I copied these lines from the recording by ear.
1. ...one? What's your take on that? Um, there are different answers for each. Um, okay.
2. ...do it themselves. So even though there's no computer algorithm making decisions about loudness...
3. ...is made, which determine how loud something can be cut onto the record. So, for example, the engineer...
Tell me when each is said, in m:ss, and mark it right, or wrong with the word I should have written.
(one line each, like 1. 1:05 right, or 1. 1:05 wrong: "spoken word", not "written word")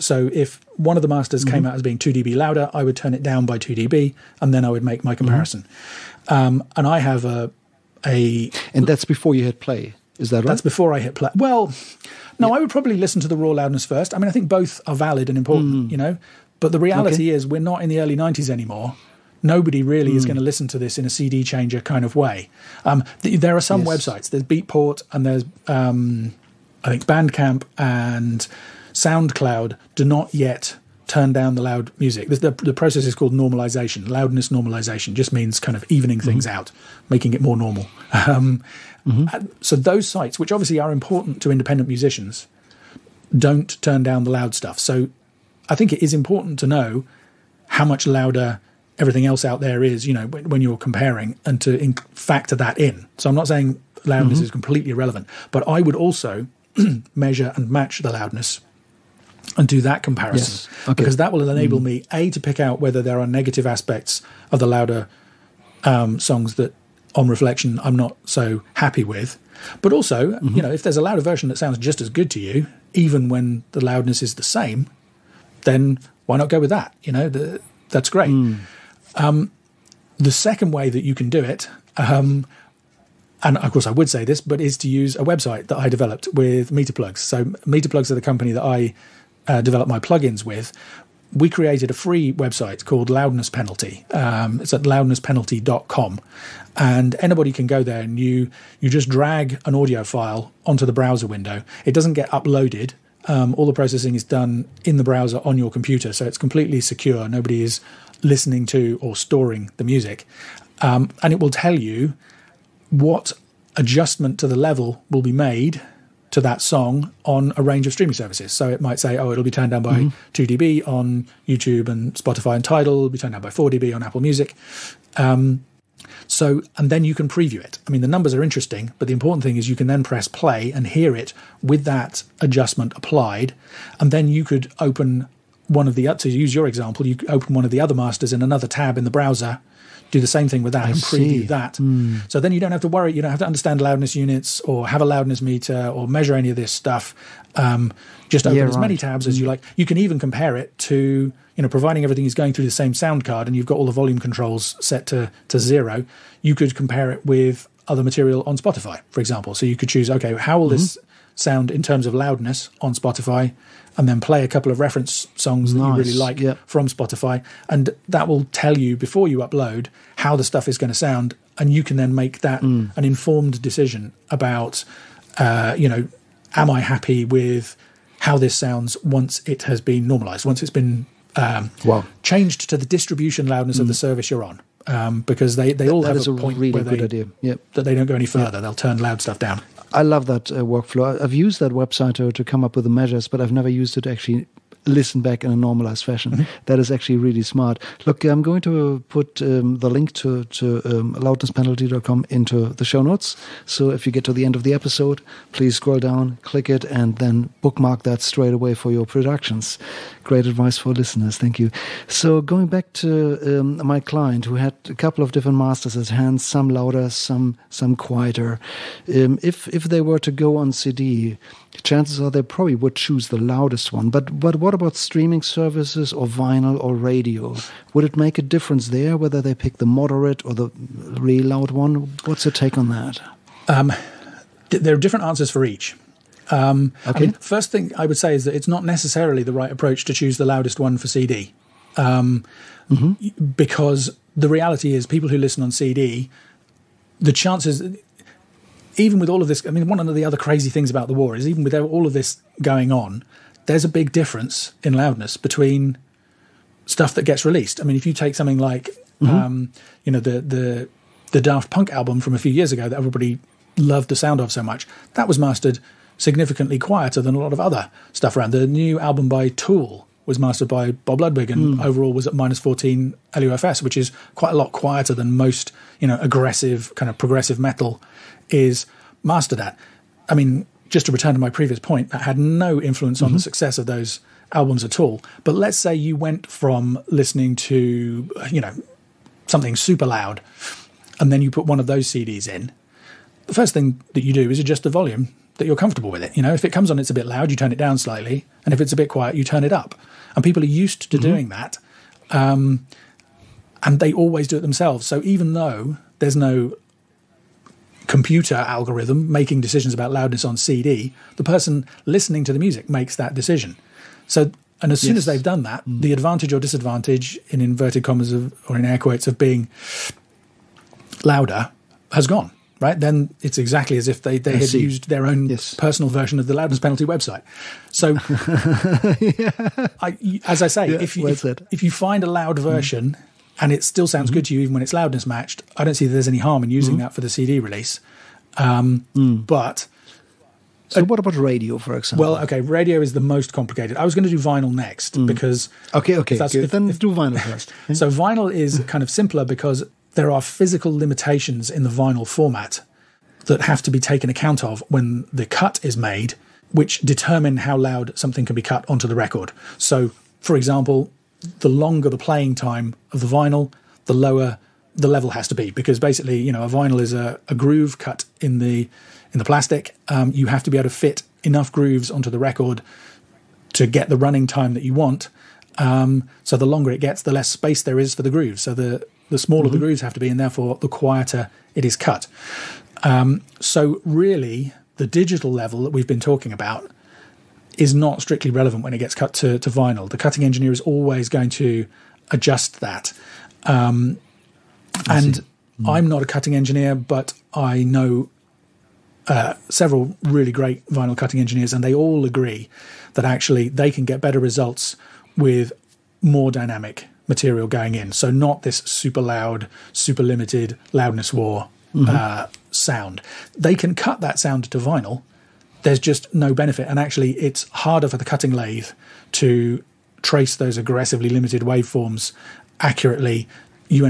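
1. 3:51 right
2. 5:04 right
3. 5:55 wrong: "longer", not "engineer".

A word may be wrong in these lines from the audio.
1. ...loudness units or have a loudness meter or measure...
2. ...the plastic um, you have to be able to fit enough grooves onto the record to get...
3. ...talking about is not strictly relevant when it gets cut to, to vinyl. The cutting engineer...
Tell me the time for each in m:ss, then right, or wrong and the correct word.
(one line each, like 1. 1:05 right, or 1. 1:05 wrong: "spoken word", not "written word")
1. 2:23 right
2. 6:09 right
3. 6:26 right.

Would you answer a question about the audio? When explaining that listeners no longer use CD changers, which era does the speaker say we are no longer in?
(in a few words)
the early 90s.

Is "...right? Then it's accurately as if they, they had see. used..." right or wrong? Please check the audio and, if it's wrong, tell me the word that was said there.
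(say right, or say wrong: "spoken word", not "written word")
wrong: "exactly", not "accurately".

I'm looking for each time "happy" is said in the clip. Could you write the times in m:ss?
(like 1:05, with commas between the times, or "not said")
1:08, 2:56.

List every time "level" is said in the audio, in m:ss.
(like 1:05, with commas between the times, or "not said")
1:54, 6:05, 6:25.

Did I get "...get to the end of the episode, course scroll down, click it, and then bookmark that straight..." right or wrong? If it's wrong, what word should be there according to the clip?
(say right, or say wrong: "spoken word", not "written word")
wrong: "please", not "course".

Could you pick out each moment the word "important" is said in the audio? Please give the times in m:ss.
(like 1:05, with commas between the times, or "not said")
0:15, 0:40, 0:46, 2:09.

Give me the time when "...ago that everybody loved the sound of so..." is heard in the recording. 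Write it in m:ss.
4:22.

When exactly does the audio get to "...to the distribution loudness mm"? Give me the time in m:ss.
3:02.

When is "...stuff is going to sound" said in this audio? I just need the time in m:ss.
2:50.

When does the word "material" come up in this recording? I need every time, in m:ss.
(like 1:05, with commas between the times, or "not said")
2:38, 6:47.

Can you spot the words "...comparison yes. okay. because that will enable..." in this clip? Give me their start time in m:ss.
1:00.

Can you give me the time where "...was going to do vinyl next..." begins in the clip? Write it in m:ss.
5:44.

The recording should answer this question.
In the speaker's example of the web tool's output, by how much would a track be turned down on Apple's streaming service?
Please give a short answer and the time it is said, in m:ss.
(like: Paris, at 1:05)
4dB, at 2:03.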